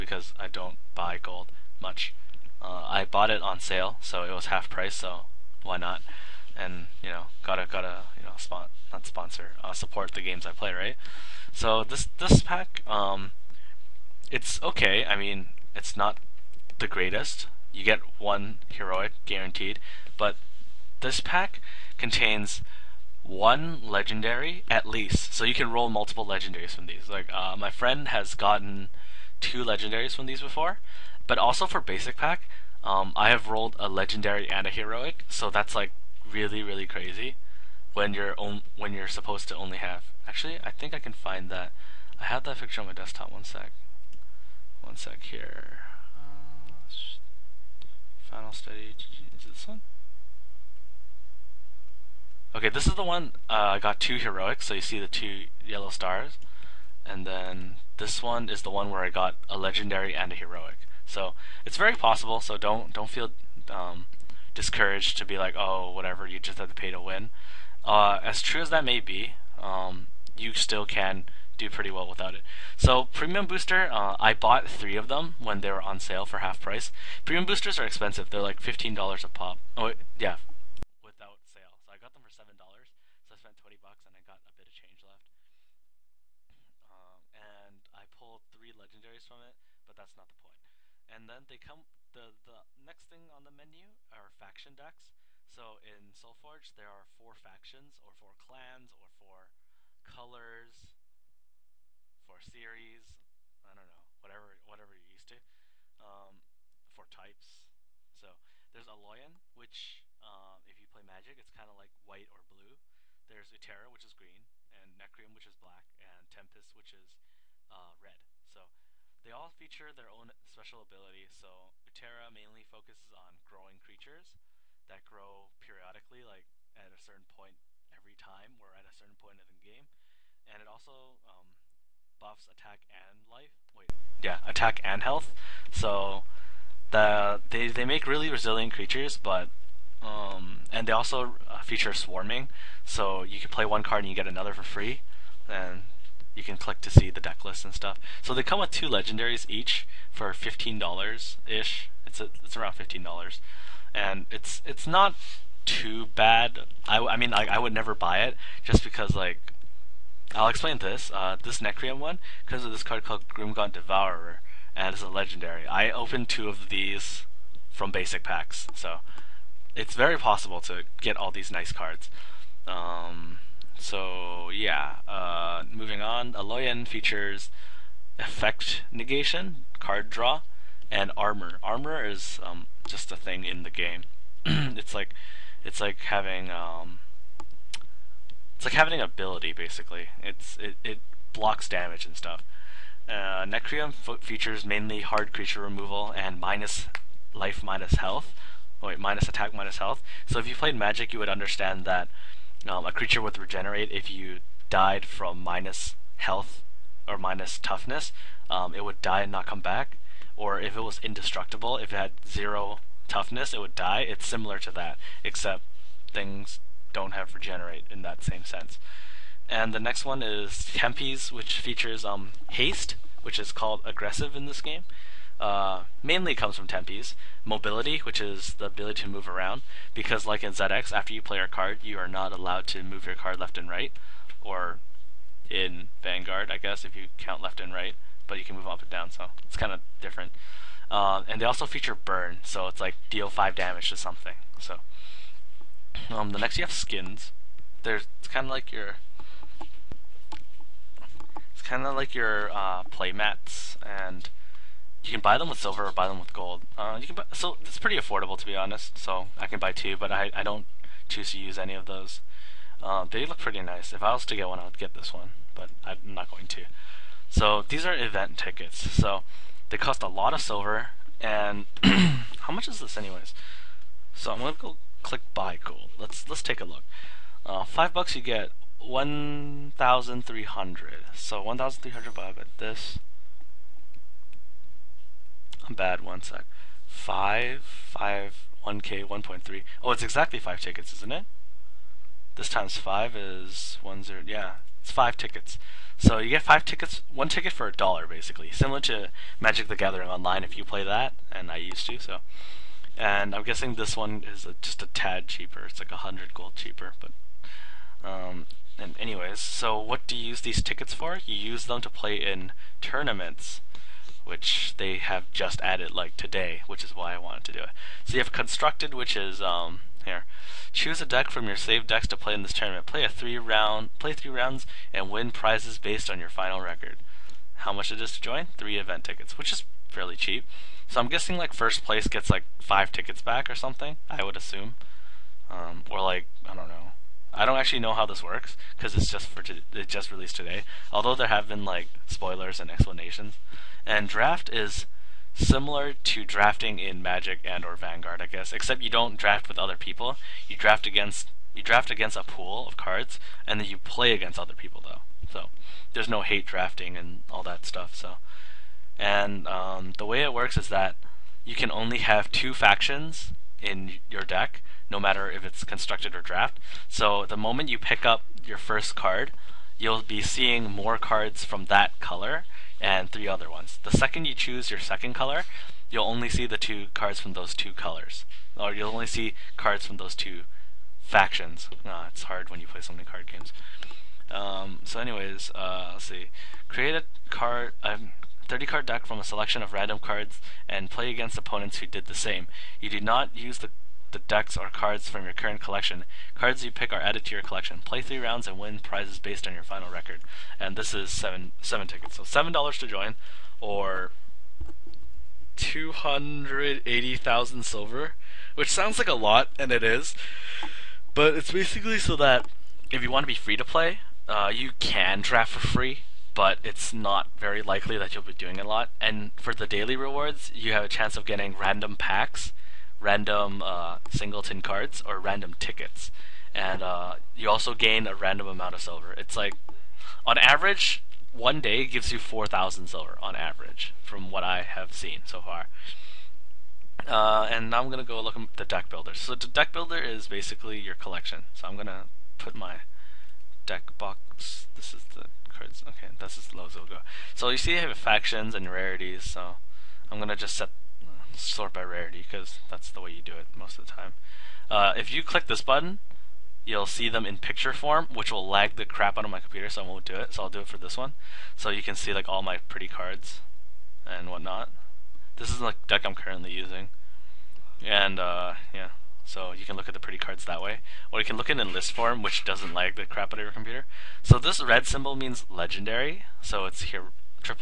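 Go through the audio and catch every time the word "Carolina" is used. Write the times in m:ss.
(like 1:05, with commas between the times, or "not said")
not said.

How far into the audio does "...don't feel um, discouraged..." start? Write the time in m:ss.
1:02.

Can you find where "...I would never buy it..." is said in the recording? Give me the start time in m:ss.
2:37.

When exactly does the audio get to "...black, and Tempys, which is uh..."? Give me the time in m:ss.
1:55.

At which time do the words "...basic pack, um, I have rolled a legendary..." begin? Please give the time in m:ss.
0:31.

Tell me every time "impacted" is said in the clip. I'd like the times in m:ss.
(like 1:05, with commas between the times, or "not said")
not said.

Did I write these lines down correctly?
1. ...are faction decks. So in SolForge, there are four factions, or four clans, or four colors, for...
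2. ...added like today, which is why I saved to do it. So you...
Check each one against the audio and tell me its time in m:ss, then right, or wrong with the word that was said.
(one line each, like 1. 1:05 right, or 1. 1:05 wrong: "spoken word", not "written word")
1. 1:34 right
2. 5:15 wrong: "wanted", not "saved".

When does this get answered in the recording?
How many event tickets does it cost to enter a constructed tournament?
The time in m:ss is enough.
5:28.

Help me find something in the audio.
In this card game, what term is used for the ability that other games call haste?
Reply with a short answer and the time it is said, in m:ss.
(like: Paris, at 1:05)
aggressive, at 3:43.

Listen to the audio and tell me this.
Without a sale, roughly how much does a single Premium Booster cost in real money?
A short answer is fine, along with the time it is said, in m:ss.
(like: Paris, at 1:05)
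$15, at 1:18.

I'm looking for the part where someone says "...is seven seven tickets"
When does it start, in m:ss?
6:40.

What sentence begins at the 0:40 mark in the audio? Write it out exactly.
Actually, I think I can find that.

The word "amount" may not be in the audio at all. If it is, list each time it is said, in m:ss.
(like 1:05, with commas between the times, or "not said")
7:08.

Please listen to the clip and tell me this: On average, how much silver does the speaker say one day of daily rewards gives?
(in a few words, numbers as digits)
4,000.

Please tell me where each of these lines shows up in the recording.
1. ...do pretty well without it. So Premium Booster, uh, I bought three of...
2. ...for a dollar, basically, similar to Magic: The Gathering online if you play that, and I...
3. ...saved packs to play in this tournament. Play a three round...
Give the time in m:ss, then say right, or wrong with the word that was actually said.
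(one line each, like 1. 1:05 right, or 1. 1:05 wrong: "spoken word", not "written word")
1. 1:11 right
2. 4:57 right
3. 5:21 wrong: "decks", not "packs".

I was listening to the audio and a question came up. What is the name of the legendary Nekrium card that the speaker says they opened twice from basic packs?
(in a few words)
Grimgaunt Devourer.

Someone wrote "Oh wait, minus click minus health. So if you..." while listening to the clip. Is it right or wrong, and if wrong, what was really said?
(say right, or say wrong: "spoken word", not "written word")
wrong: "attack", not "click".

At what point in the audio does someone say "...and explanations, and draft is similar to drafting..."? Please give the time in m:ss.
5:42.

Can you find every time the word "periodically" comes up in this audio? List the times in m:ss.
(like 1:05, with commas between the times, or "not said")
2:05.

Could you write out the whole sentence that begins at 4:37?
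Uh, five bucks, you get one thousand three hundred.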